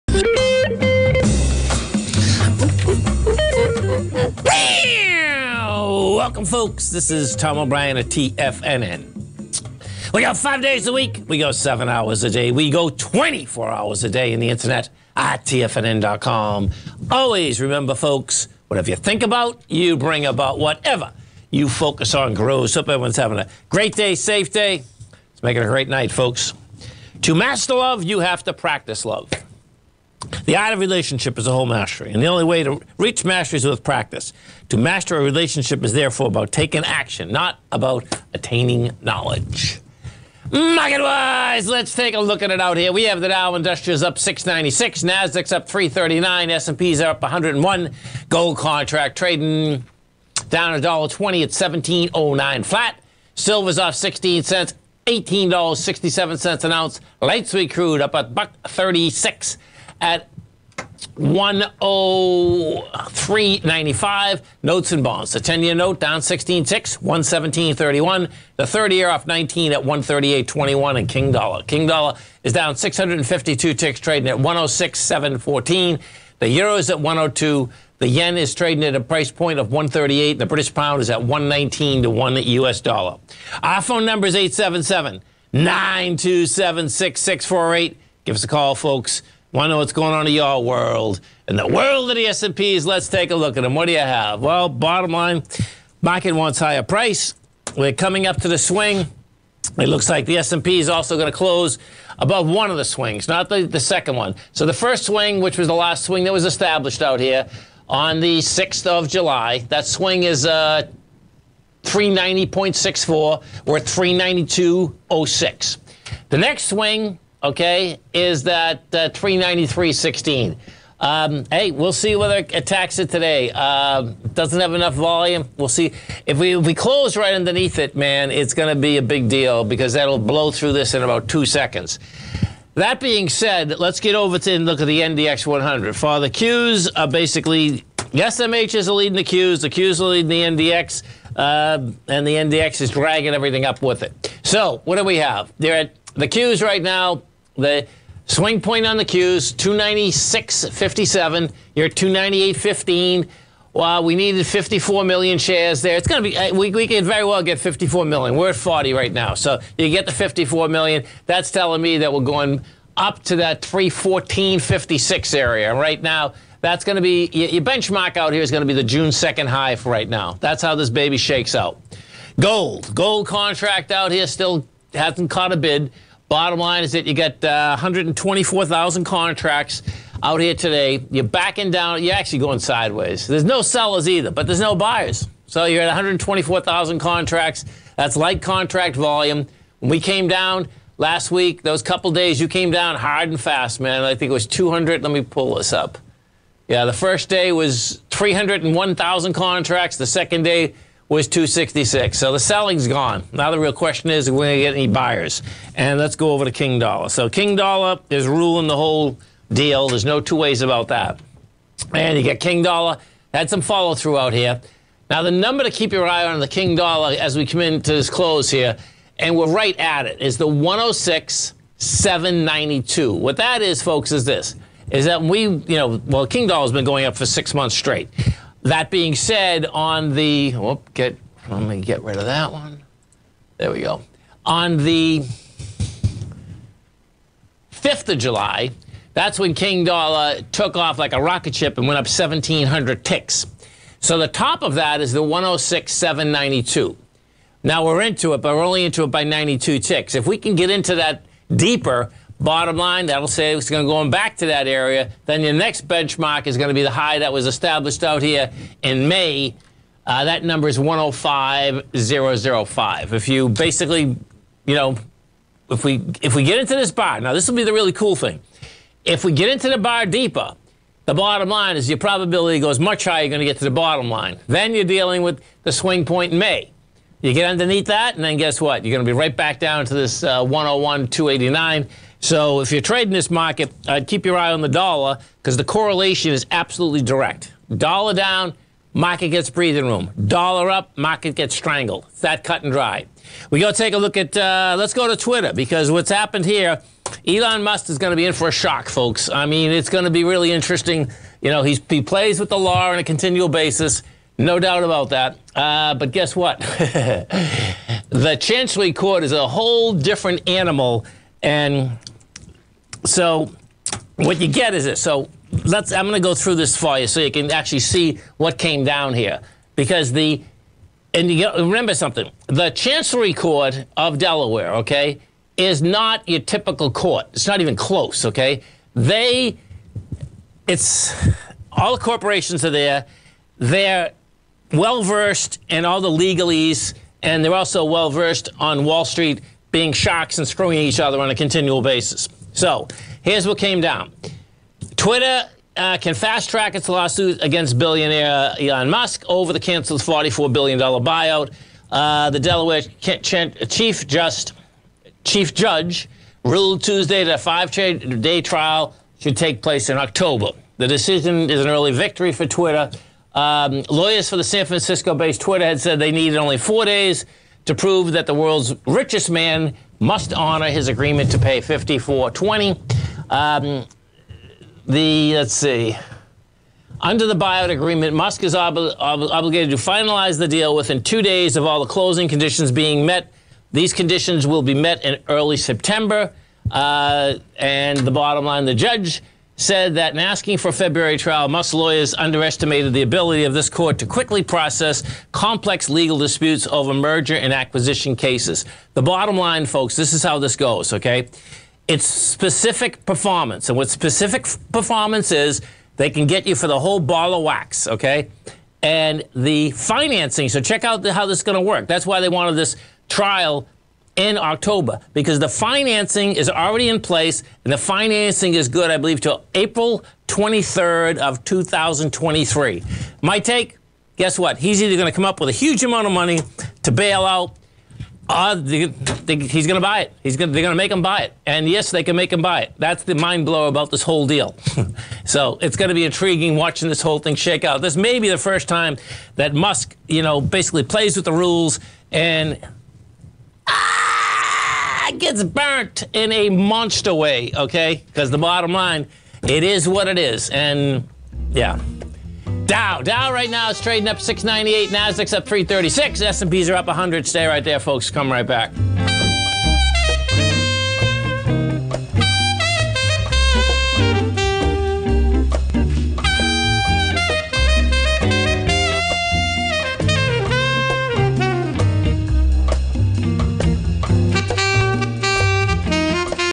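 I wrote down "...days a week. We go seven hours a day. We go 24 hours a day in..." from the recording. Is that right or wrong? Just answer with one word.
right.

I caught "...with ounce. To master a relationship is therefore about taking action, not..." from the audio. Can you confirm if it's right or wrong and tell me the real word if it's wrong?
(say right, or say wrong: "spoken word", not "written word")
wrong: "practice", not "ounce".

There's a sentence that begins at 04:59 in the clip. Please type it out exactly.
I mean, it's going to be really interesting.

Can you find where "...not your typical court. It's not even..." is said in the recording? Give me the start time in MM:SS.
05:25.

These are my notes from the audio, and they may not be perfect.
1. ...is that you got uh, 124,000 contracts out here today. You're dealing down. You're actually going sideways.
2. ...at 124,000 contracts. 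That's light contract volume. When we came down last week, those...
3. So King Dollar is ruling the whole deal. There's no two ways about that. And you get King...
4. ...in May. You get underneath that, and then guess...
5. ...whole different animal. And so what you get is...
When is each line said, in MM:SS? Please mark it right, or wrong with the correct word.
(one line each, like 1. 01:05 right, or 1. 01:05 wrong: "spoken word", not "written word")
1. 02:56 wrong: "backing", not "dealing"
2. 03:05 right
3. 03:27 right
4. 04:36 right
5. 05:09 right.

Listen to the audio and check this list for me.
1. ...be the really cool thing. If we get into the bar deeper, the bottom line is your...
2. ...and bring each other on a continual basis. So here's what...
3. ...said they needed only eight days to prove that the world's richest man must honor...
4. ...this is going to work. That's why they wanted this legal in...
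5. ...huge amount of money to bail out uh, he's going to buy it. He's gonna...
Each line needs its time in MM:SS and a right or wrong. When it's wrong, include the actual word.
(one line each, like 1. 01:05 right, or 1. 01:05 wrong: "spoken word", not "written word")
1. 04:27 right
2. 05:40 wrong: "screwing", not "bring"
3. 06:05 wrong: "four", not "eight"
4. 06:51 wrong: "trial", not "legal"
5. 07:05 right.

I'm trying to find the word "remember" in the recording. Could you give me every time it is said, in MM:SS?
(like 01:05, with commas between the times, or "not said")
00:17, 05:21.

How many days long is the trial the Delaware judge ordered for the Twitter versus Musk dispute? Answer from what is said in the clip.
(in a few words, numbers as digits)
5 days.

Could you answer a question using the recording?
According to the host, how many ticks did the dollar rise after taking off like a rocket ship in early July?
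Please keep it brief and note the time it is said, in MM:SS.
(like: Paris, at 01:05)
1,700, at 04:02.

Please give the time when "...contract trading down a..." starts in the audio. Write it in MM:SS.
00:48.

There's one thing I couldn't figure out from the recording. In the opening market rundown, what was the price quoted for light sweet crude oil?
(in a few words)
103.95.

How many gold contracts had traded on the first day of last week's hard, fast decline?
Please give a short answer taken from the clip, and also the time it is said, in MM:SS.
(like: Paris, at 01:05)
301,000, at 03:18.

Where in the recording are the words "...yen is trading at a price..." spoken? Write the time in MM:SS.
01:18.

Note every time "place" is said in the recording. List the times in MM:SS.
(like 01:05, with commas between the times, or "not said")
05:59, 06:56.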